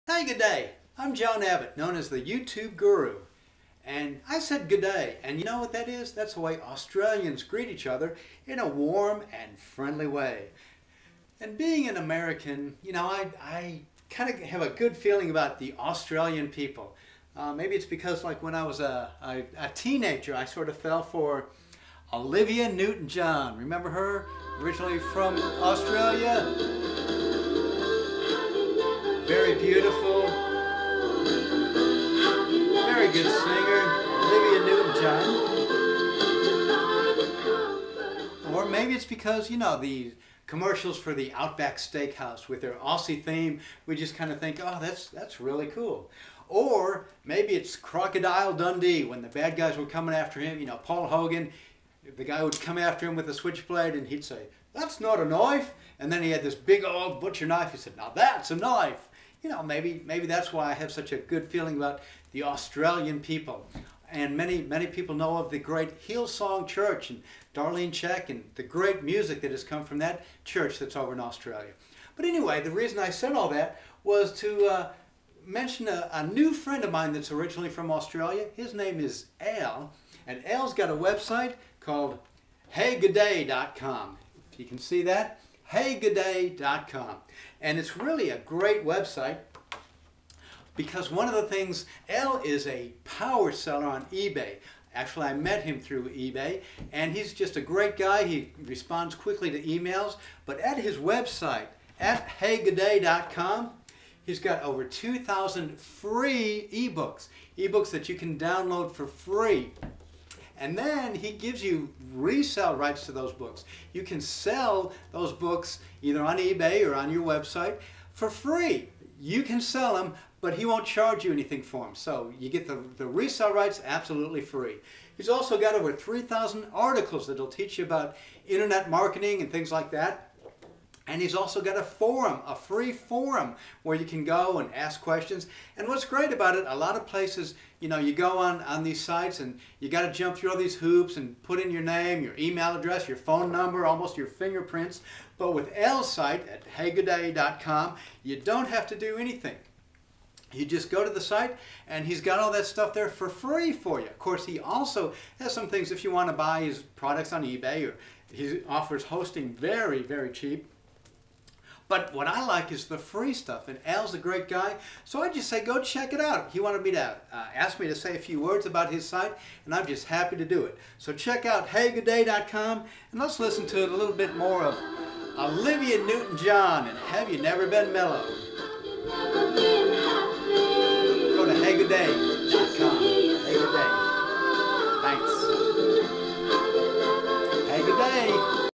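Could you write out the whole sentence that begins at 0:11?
And being an American, you know, I, I kind of have a good feeling about the Australian people.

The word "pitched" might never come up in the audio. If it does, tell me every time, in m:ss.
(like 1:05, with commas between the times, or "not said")
not said.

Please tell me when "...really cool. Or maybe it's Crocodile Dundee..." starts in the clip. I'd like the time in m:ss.
0:45.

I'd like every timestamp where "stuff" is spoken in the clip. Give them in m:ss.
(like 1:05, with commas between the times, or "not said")
2:32, 2:43.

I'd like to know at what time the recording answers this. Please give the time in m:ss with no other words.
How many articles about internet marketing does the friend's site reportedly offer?
2:05.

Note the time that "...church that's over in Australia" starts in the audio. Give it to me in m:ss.
1:10.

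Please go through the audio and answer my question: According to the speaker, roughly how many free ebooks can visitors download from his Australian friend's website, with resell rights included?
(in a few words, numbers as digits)
over 2,000.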